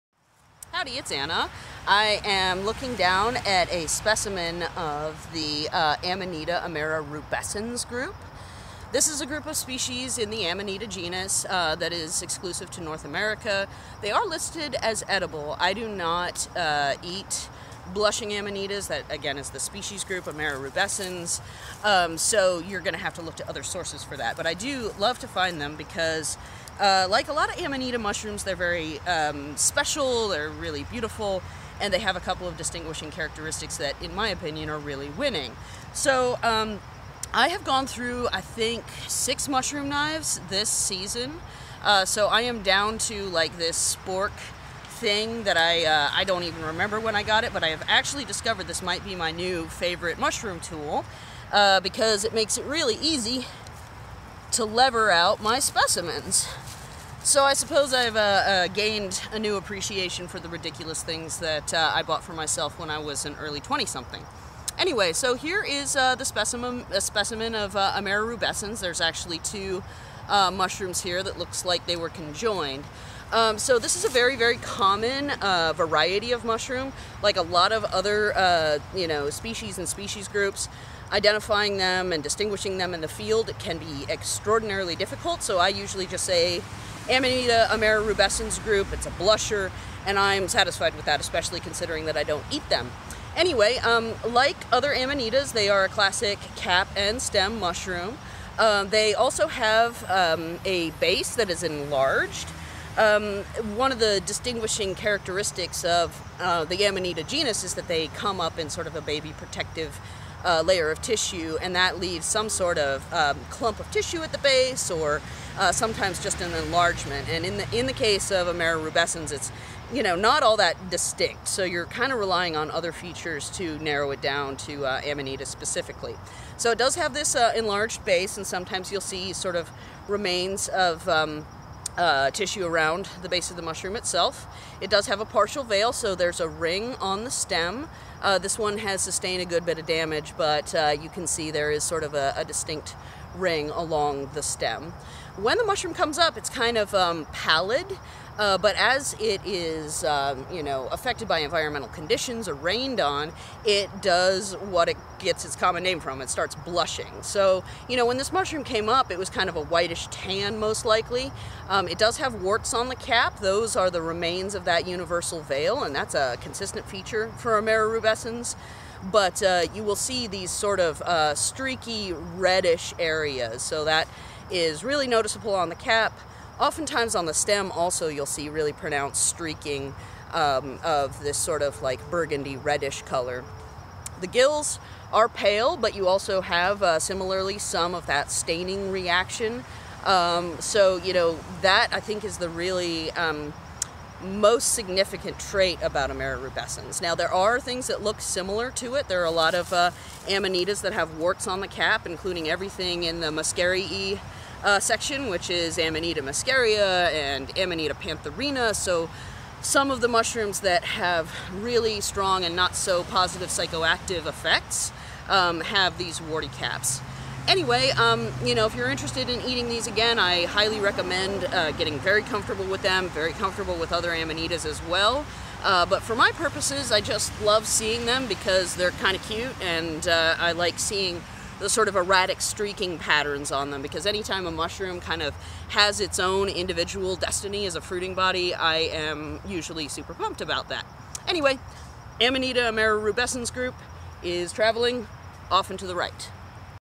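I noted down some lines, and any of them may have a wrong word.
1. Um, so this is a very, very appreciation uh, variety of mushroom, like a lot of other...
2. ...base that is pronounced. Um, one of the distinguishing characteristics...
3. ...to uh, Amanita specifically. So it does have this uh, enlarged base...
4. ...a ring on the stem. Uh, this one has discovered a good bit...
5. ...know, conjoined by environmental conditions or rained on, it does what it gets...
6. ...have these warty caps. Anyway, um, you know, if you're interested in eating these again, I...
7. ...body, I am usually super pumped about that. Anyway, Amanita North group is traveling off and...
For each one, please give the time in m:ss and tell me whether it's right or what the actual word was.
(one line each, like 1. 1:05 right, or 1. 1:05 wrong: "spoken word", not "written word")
1. 1:13 wrong: "common", not "appreciation"
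2. 1:40 wrong: "enlarged", not "pronounced"
3. 2:04 right
4. 2:16 wrong: "sustained", not "discovered"
5. 2:30 wrong: "affected", not "conjoined"
6. 3:35 right
7. 3:58 wrong: "Rubescens", not "North".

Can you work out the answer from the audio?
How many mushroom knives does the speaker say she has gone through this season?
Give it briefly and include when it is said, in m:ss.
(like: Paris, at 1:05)
6, at 0:39.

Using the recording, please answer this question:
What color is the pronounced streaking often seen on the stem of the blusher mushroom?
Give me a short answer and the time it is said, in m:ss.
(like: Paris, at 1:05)
Burgundy reddish, at 3:02.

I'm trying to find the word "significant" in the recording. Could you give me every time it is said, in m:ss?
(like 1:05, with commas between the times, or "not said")
3:14.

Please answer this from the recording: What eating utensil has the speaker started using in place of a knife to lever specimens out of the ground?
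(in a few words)
Spork.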